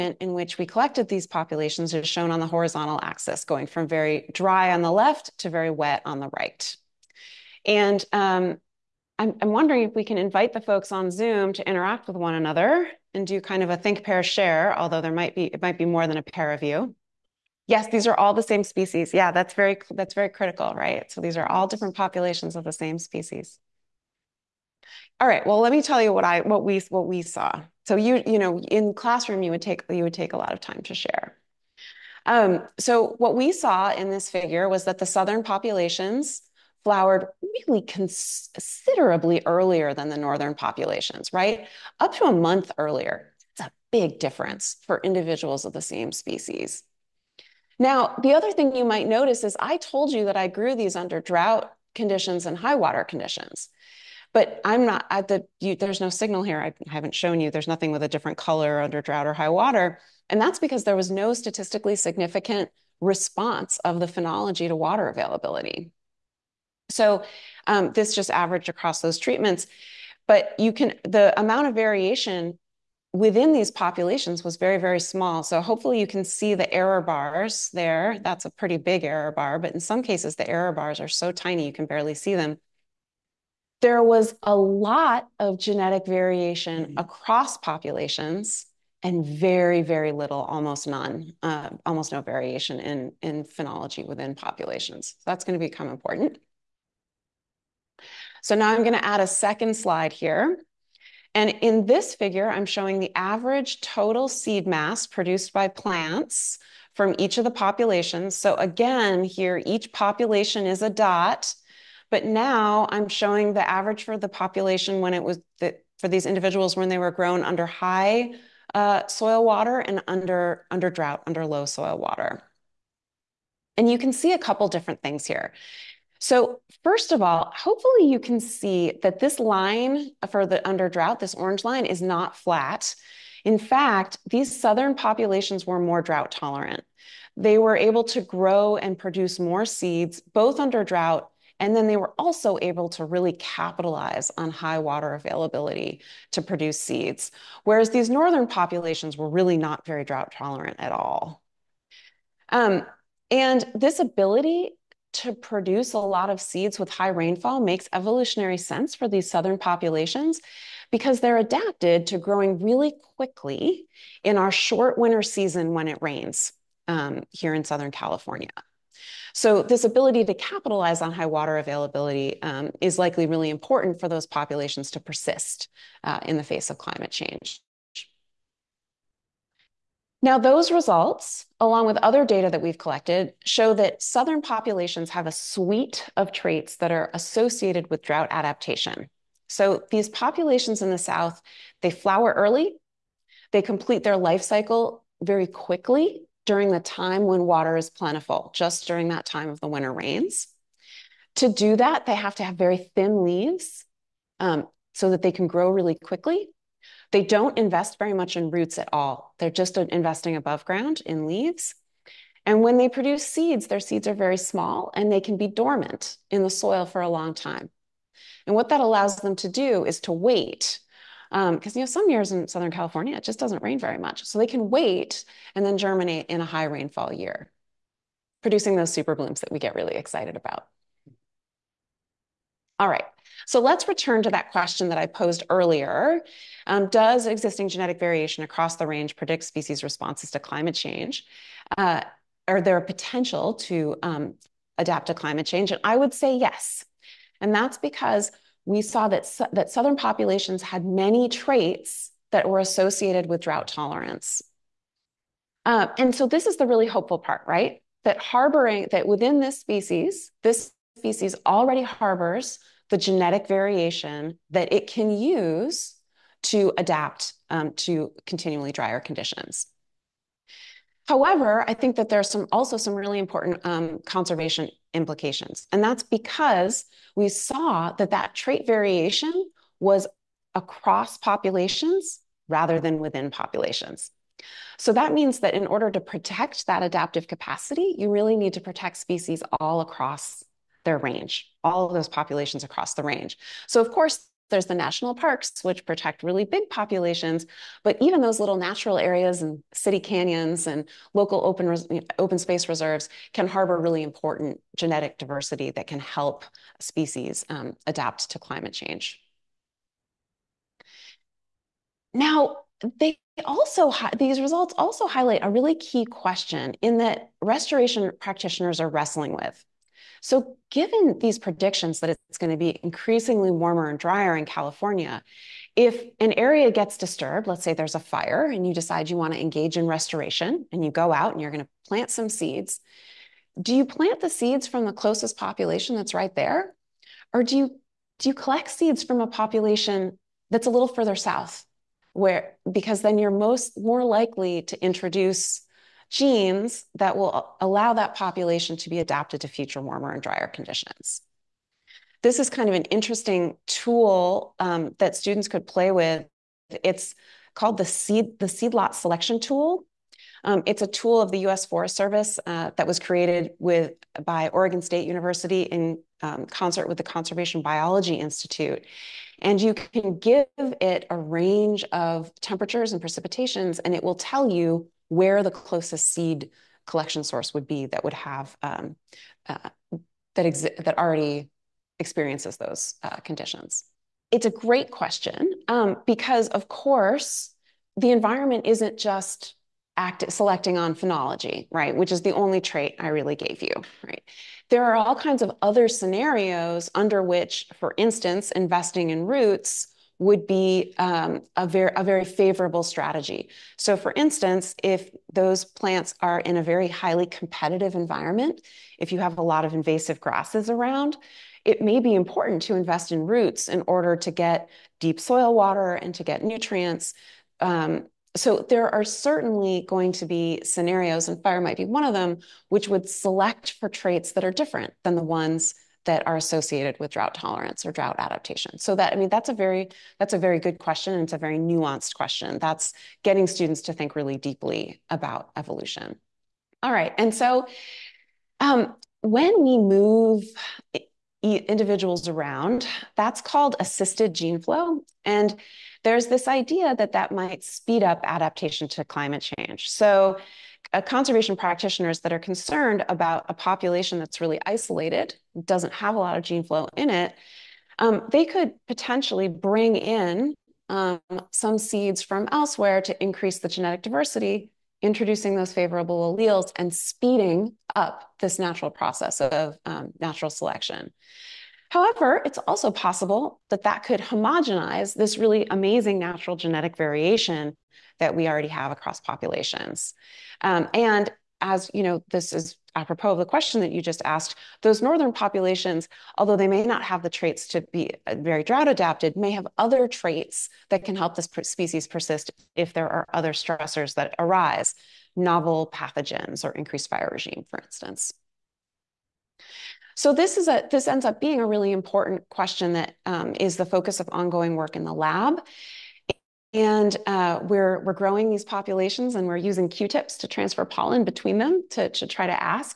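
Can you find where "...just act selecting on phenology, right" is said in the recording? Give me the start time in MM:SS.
06:28.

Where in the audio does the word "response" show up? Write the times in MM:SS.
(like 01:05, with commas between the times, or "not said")
01:03, 03:59.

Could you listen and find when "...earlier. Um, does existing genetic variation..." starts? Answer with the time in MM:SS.
03:55.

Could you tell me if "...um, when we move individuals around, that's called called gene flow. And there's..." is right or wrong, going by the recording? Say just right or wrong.
wrong.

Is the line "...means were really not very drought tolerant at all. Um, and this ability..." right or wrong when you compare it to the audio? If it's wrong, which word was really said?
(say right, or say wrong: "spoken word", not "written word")
wrong: "populations", not "means".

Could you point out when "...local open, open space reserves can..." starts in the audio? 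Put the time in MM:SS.
05:01.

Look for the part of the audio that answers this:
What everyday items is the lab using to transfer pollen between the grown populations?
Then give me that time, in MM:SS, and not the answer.
08:29.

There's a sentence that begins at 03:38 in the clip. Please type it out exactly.
And what that allows them to do is to wait.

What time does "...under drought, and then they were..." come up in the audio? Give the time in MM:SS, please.
02:20.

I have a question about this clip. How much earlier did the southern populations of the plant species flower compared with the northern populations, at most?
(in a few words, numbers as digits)
A month.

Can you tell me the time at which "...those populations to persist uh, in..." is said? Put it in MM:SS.
02:54.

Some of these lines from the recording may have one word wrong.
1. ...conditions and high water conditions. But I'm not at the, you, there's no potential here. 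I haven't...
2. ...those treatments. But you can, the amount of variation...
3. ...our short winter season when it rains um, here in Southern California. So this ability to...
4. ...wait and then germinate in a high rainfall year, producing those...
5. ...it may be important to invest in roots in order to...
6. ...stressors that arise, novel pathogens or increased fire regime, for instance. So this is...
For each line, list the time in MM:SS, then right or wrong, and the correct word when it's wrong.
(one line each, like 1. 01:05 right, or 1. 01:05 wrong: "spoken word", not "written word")
1. 00:51 wrong: "signal", not "potential"
2. 01:09 right
3. 02:44 right
4. 03:44 right
5. 06:51 right
6. 08:13 right.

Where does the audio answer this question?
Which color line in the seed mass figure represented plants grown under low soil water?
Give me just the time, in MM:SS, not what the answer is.
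02:11.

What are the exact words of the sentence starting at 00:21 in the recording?
So these are all different populations of the same species.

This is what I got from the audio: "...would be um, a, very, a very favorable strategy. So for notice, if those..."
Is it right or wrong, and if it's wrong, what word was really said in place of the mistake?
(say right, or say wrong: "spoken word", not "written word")
wrong: "instance", not "notice".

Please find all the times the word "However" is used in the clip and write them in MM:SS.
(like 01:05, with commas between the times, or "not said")
04:31, 07:51.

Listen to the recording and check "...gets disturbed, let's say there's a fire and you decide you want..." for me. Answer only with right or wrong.
right.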